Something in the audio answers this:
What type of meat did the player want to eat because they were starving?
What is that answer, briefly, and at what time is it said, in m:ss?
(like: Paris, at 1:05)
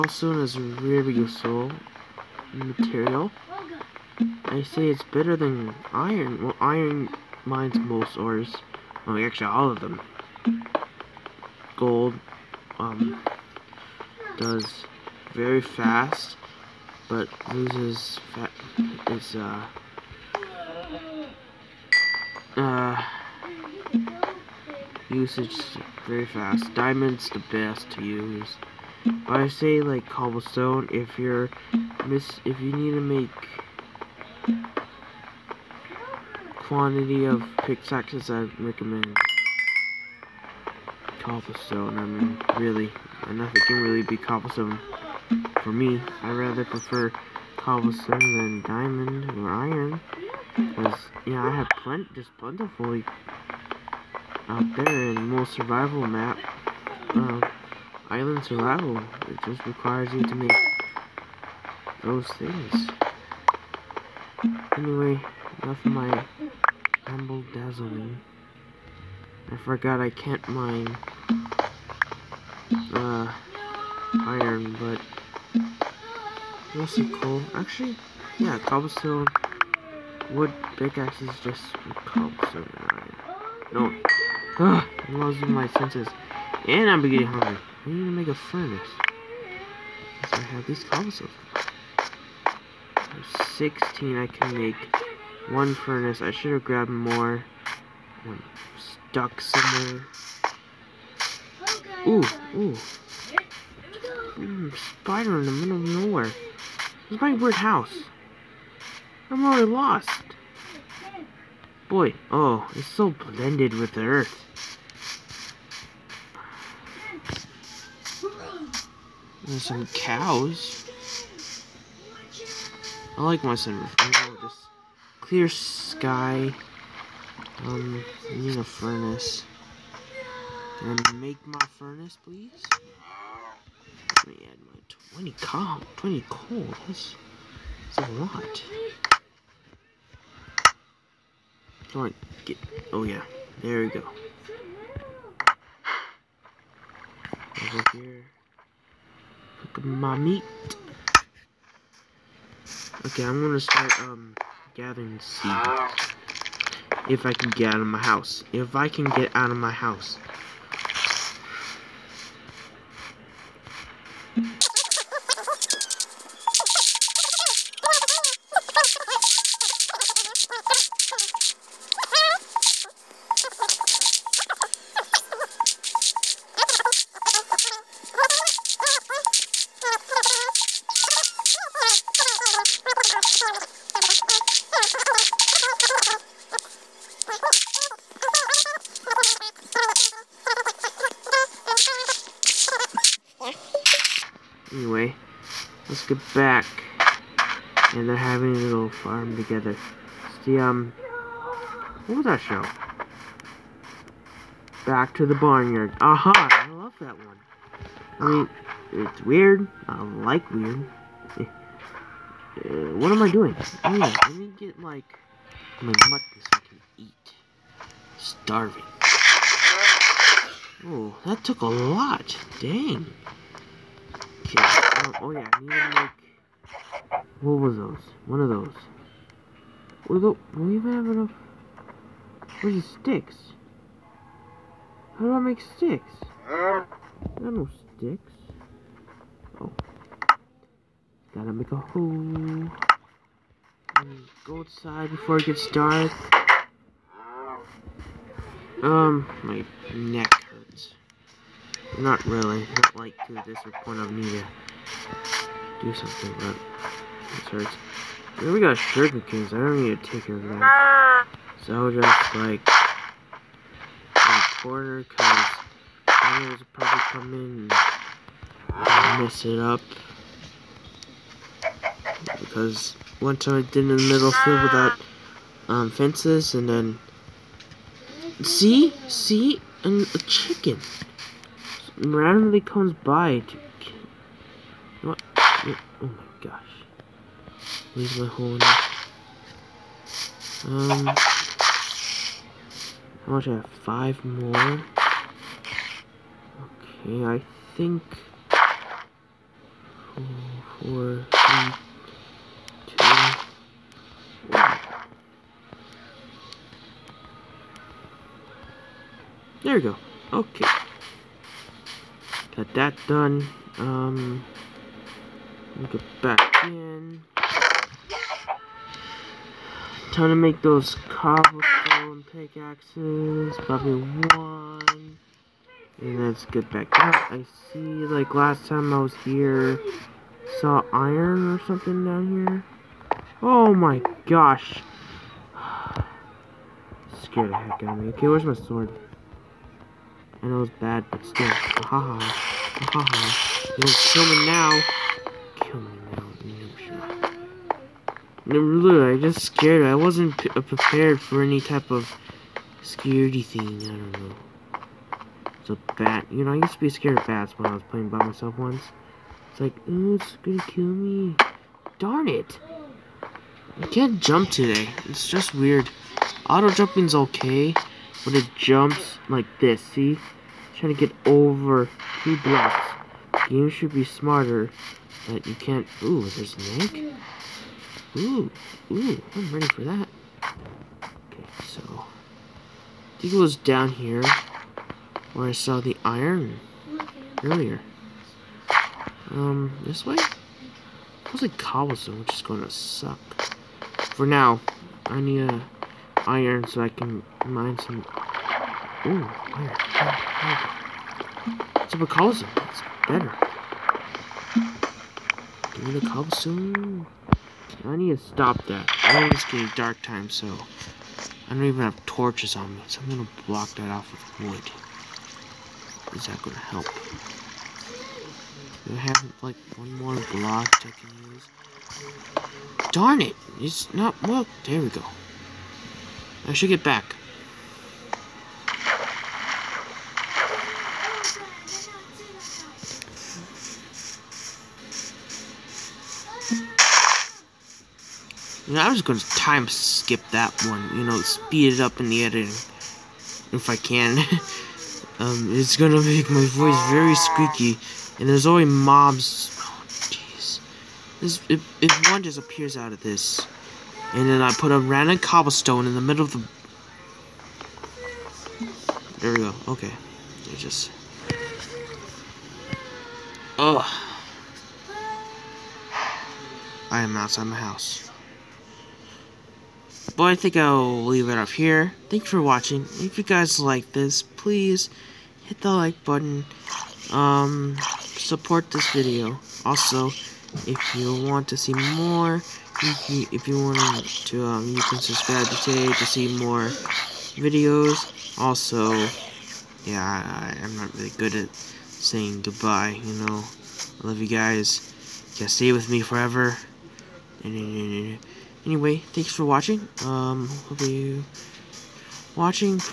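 Mutton, at 3:36.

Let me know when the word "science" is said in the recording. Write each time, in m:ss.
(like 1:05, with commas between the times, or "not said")
not said.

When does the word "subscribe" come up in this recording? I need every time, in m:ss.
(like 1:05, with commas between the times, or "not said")
8:04.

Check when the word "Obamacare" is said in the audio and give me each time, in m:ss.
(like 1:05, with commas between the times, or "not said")
not said.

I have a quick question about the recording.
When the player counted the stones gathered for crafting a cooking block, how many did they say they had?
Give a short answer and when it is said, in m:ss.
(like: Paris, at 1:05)
16, at 1:32.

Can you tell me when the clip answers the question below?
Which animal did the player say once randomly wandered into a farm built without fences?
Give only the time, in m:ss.
4:40.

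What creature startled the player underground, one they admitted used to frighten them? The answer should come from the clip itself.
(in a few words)
A bat.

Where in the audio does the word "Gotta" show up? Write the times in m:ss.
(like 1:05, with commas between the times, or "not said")
4:01.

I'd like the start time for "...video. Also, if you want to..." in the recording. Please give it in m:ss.
7:58.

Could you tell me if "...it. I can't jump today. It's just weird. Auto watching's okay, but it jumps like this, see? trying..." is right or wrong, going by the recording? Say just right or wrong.
wrong.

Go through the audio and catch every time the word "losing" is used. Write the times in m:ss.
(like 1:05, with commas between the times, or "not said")
1:25.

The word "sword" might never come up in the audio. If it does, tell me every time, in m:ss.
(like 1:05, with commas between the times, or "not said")
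5:38.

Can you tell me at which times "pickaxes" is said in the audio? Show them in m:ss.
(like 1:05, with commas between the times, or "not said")
0:37, 1:20, 5:22.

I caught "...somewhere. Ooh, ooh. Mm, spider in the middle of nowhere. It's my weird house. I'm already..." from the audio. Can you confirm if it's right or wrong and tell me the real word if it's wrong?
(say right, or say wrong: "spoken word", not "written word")
right.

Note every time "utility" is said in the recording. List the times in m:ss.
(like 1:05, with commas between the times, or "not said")
not said.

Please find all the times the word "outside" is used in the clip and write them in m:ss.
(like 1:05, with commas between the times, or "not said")
4:04, 7:47.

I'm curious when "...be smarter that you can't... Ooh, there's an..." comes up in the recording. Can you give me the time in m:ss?
6:13.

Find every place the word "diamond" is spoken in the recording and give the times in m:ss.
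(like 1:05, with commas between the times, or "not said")
0:26, 0:48.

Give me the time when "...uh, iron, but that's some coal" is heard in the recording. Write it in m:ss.
1:12.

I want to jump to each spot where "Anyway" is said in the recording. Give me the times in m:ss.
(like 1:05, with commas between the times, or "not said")
1:04, 3:14, 8:18.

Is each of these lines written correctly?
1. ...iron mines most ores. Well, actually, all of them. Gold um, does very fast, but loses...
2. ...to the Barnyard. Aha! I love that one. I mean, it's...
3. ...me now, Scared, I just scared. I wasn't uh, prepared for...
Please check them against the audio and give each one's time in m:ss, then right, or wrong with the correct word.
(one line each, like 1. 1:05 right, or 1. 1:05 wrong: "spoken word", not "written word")
1. 0:06 right
2. 3:25 right
3. 5:45 wrong: "Literally", not "Scared".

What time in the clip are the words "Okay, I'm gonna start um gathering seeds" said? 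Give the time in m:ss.
2:33.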